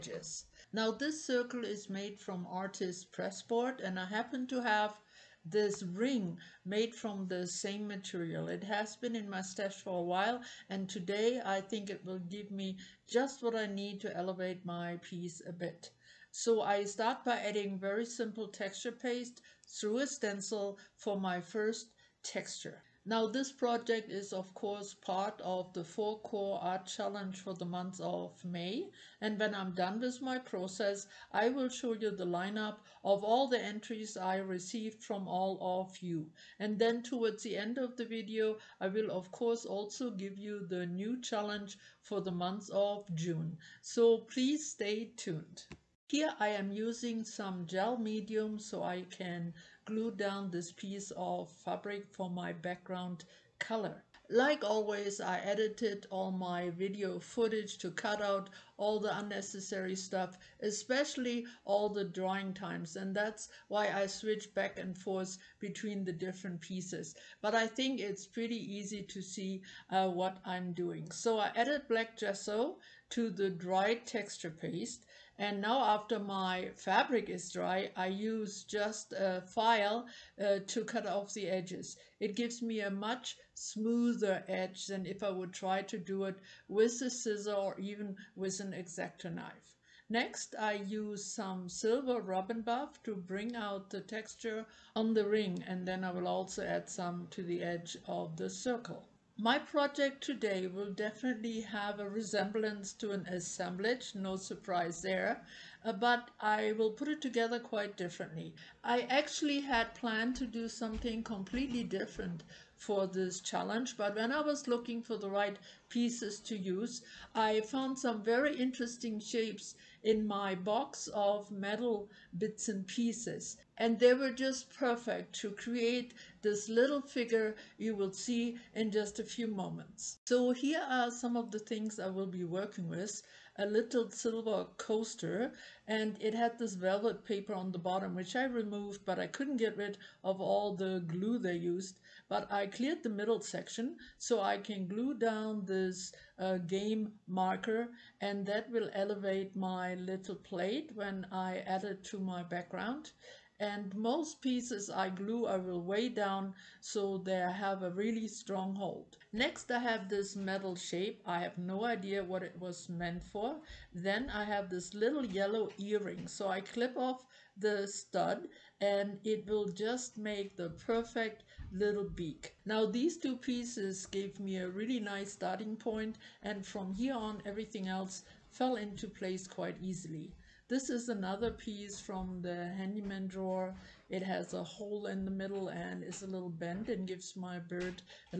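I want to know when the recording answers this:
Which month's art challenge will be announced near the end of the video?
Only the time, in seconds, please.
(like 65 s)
43 s.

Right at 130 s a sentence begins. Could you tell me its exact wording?
So here are some of the things I will be working with.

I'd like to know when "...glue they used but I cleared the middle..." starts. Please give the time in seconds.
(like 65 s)
141 s.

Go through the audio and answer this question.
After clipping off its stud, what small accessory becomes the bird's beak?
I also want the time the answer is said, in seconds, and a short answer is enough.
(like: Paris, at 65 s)
yellow earring, at 165 s.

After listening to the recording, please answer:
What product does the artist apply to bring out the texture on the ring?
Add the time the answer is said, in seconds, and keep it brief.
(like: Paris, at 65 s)
silver Rub 'n Buff, at 91 s.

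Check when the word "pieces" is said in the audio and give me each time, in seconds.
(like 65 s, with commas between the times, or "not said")
15 s, 50 s, 66 s, 115 s, 122 s, 154 s, 173 s, 181 s.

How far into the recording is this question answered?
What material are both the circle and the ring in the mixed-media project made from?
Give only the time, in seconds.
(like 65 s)
2 s.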